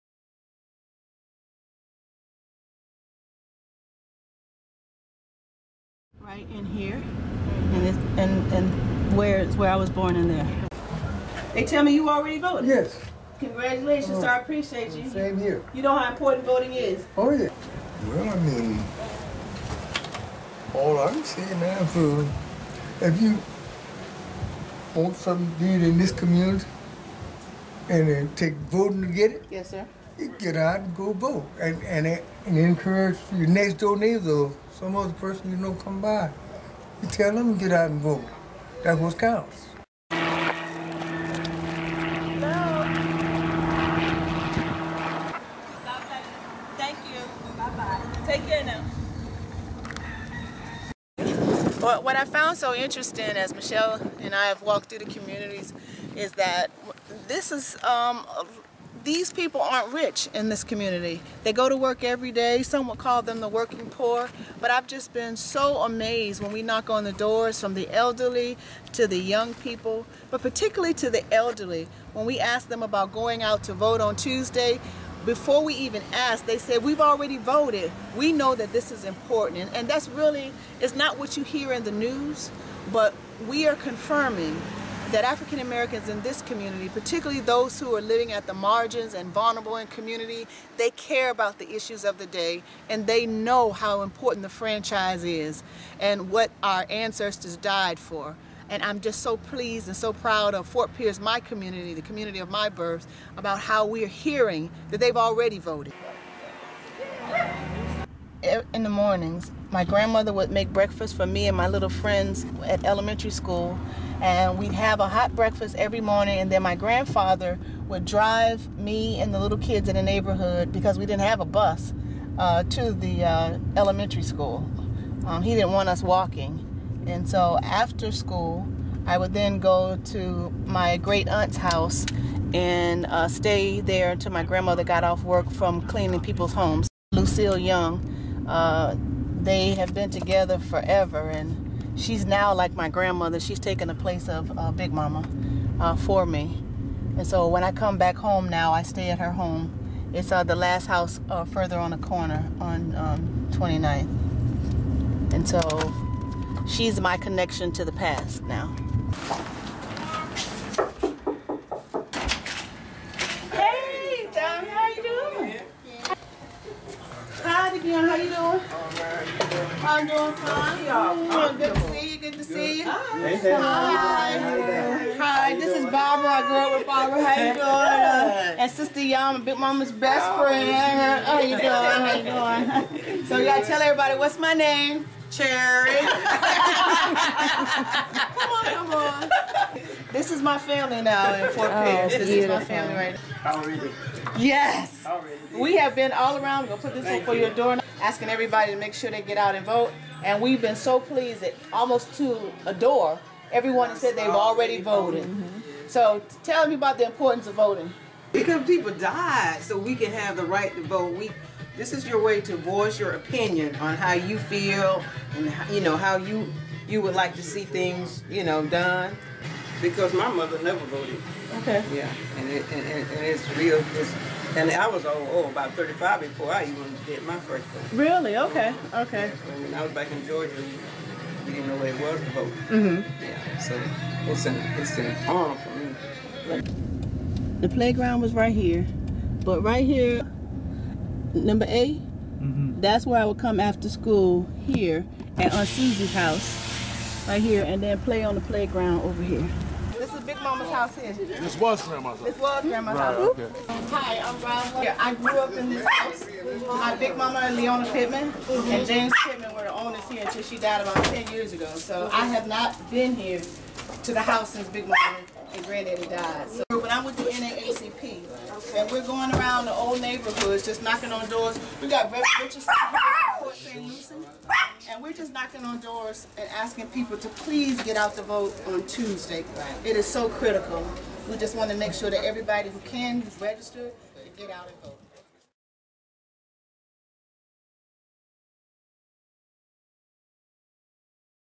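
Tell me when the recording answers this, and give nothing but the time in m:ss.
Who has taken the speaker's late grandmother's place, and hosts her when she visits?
2:17.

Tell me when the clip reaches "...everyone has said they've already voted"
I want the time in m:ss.
3:23.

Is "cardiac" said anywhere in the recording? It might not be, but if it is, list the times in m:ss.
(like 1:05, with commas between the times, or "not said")
not said.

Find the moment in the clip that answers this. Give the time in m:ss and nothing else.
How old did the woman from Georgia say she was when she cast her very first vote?
3:45.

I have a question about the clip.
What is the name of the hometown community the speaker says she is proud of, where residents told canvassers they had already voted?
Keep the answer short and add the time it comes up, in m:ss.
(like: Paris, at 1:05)
Fort Pierce, at 1:40.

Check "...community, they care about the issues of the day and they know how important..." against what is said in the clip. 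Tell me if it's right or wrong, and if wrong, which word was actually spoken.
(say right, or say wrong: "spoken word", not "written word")
right.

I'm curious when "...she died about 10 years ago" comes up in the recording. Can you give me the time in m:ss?
4:20.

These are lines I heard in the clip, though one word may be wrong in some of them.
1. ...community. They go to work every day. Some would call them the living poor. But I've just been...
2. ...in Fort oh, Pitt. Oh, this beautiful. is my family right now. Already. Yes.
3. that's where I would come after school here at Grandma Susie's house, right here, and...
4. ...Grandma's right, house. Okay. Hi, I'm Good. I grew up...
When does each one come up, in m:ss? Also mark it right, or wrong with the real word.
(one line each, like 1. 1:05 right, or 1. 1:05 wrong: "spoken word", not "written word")
1. 1:00 wrong: "working", not "living"
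2. 3:11 right
3. 4:02 wrong: "Aunt", not "Grandma"
4. 4:12 wrong: "Rob", not "Good".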